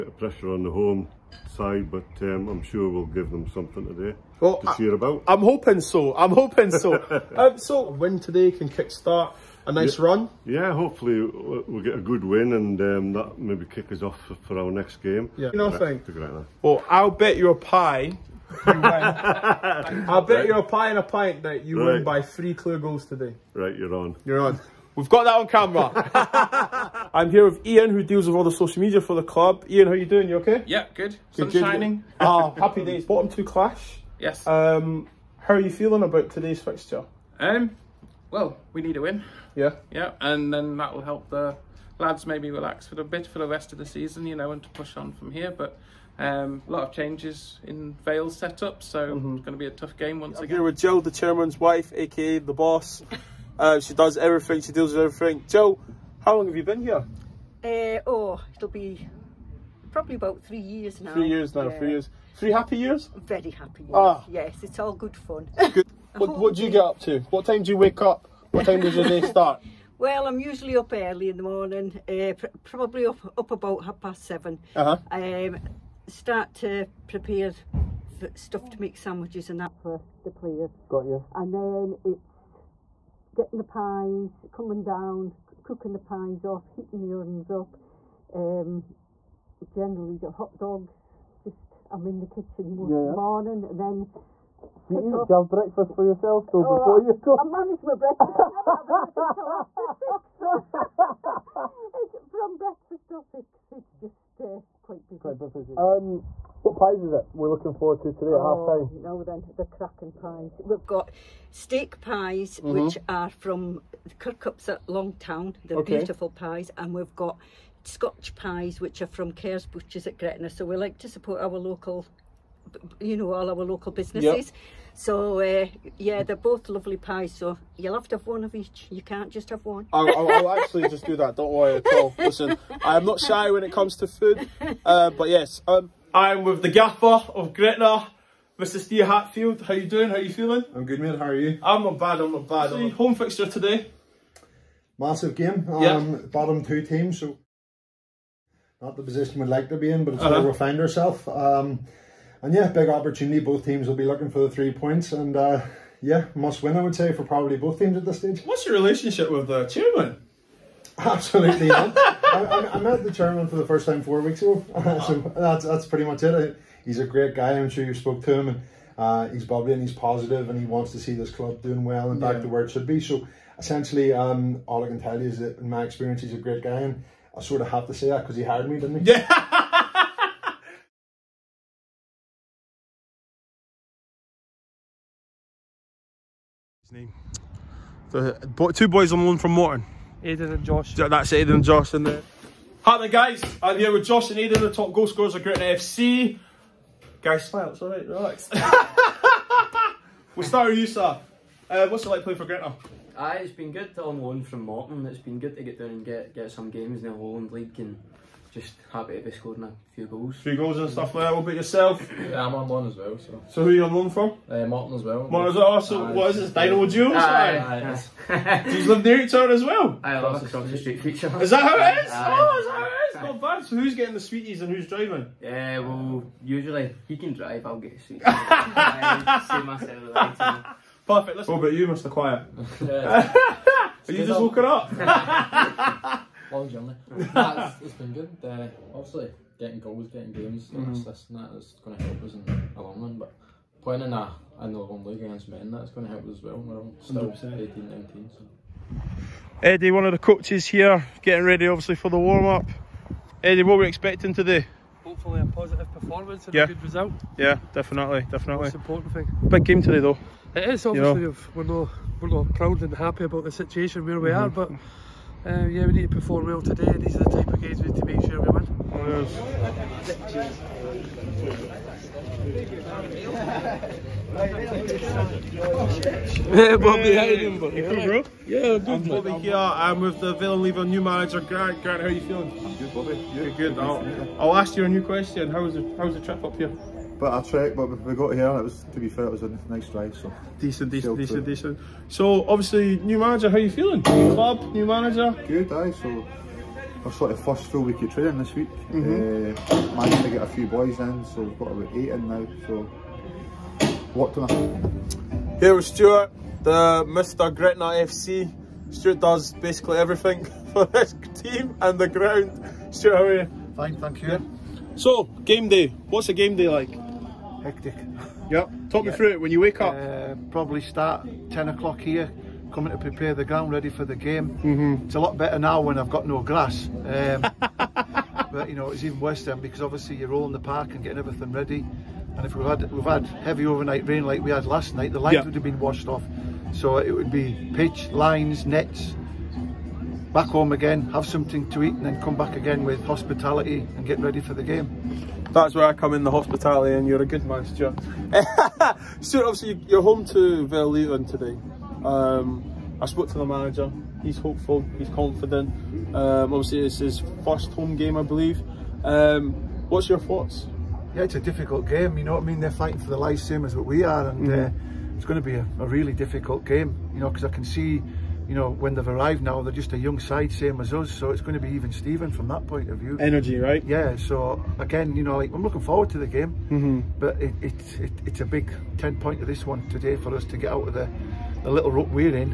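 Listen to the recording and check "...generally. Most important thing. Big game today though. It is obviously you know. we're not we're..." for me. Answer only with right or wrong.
wrong.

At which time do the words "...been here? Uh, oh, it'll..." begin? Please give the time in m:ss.
0:56.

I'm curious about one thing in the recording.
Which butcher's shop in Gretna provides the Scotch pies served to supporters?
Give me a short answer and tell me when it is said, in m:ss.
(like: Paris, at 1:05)
Kerr's Butchers, at 1:59.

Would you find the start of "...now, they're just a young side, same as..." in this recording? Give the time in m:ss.
6:09.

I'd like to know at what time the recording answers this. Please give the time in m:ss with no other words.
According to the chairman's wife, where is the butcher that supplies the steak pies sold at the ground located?
1:54.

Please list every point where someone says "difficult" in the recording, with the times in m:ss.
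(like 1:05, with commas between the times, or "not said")
6:01, 6:06.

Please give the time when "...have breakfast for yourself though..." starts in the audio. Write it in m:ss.
1:35.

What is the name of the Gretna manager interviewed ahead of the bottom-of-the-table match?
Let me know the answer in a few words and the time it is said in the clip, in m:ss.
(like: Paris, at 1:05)
Steve Hatfield, at 2:18.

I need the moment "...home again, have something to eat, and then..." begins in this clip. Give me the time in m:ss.
5:40.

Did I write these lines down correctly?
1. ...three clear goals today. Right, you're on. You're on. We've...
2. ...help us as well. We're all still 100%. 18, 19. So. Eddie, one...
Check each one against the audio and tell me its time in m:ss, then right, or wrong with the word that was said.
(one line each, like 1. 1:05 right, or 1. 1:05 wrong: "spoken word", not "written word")
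1. 0:22 right
2. 4:06 right.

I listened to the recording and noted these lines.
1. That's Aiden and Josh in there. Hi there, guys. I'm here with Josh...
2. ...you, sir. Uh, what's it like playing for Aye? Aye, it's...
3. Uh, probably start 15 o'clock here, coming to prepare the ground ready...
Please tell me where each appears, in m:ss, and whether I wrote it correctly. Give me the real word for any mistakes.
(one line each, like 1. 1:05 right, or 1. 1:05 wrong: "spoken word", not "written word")
1. 3:10 right
2. 3:20 wrong: "Gretna", not "Aye"
3. 5:19 wrong: "10", not "15".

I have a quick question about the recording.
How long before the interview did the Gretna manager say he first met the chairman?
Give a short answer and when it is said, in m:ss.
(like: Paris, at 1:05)
4 weeks, at 2:44.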